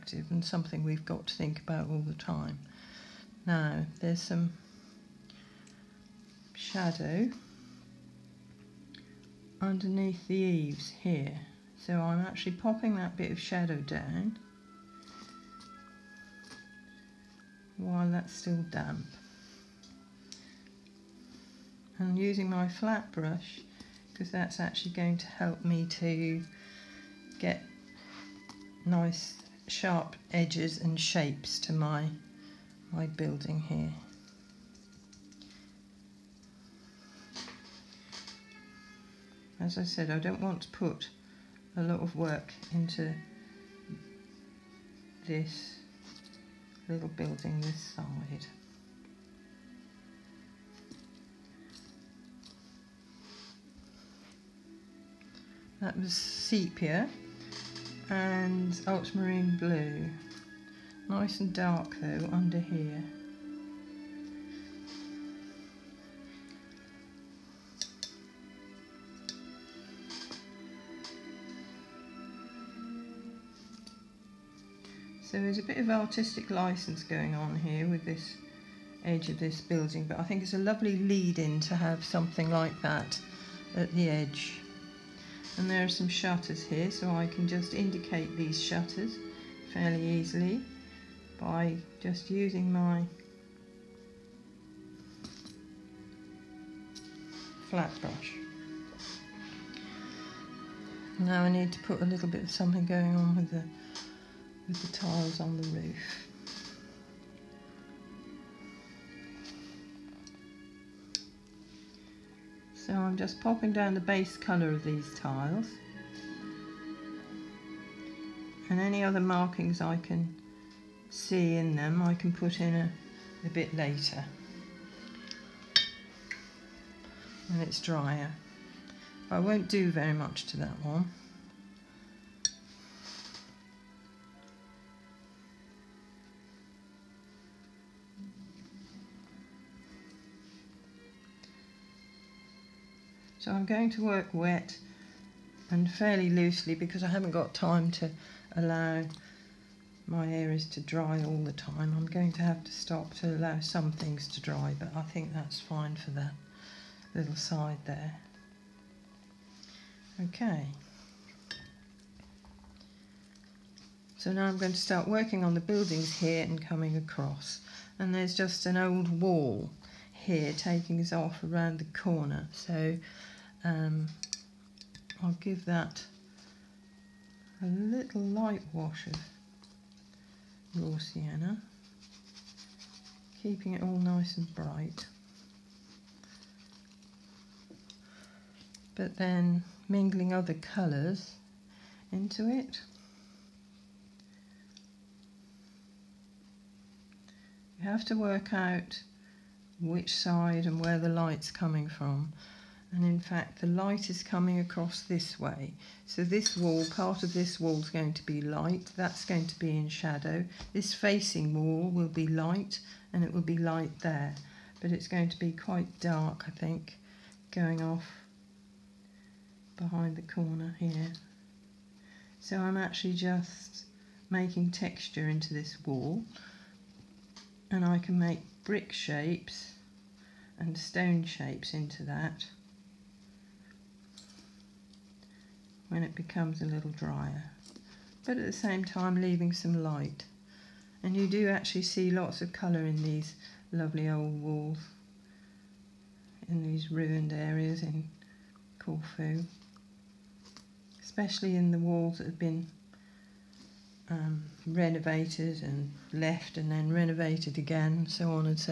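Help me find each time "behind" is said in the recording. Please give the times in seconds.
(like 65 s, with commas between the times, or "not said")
219 s.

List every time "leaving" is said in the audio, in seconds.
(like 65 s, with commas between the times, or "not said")
239 s.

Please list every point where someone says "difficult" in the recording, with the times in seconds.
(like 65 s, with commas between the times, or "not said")
not said.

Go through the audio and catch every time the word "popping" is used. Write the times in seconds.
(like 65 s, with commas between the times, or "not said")
12 s, 113 s.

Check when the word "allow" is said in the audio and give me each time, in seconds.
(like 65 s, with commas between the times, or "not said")
148 s, 153 s.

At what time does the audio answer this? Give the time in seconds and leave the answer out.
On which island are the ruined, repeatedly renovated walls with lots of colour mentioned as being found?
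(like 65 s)
248 s.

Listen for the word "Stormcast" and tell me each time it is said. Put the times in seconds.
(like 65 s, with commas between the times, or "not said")
not said.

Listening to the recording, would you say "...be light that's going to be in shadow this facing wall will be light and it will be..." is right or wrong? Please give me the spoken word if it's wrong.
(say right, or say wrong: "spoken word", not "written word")
right.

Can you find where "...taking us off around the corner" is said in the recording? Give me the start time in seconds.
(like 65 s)
170 s.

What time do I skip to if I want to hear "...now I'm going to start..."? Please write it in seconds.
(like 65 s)
164 s.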